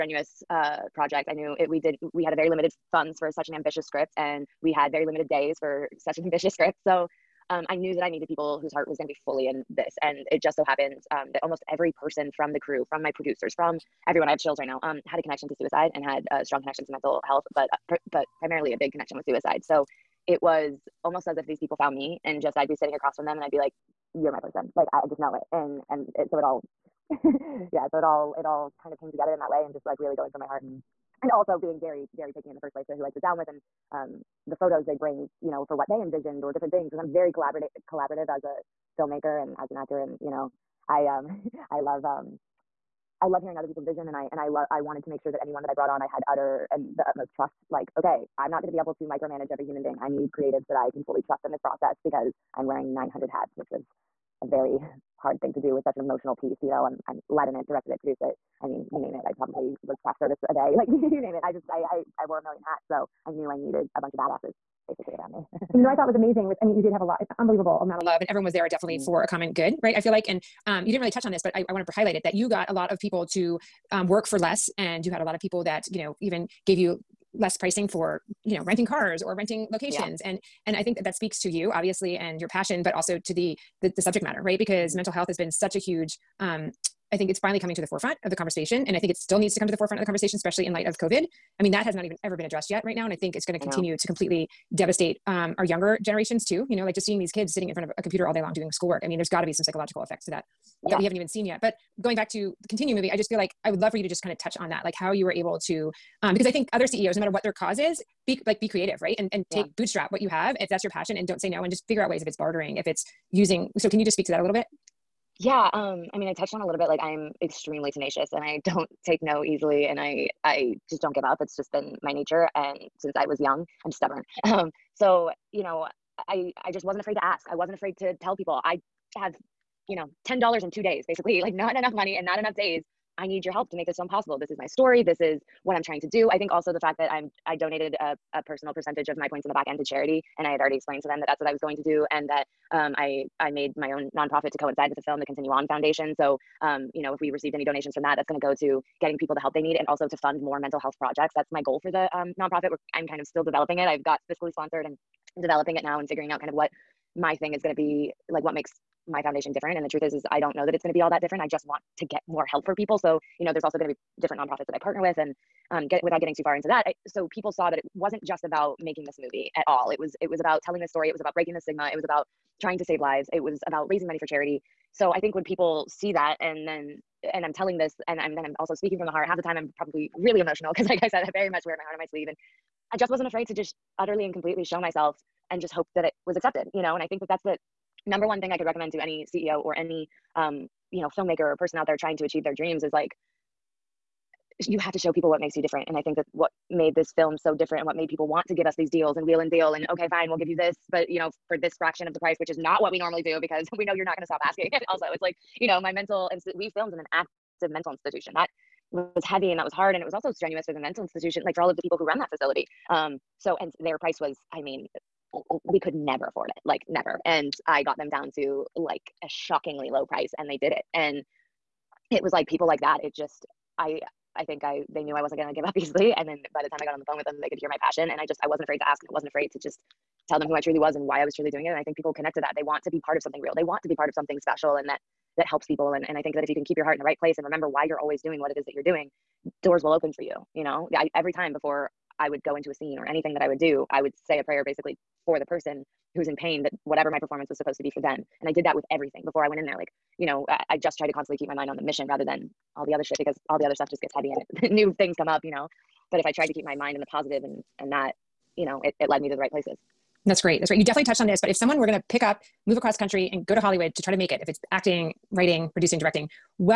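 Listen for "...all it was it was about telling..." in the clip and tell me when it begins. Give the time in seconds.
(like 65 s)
169 s.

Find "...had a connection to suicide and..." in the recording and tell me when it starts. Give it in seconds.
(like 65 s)
15 s.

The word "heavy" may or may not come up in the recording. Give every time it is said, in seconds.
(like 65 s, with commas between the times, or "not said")
209 s, 254 s.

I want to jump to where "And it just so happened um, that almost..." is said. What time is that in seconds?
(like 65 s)
10 s.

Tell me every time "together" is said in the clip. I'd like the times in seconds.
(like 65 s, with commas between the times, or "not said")
29 s.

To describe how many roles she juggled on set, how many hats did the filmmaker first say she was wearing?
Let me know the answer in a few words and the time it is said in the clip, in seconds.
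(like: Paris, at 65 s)
900, at 52 s.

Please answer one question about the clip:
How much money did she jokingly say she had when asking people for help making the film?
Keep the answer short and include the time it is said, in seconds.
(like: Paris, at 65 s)
$10, at 130 s.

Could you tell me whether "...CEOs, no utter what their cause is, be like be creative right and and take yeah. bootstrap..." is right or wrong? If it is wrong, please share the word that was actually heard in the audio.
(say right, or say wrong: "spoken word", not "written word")
wrong: "matter", not "utter".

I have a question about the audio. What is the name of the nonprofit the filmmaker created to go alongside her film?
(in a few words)
Continue On Foundation.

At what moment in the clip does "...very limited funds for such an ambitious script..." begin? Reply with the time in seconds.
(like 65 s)
2 s.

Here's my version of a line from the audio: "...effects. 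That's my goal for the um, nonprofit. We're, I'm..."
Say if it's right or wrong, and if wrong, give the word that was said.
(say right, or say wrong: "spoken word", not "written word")
wrong: "projects", not "effects".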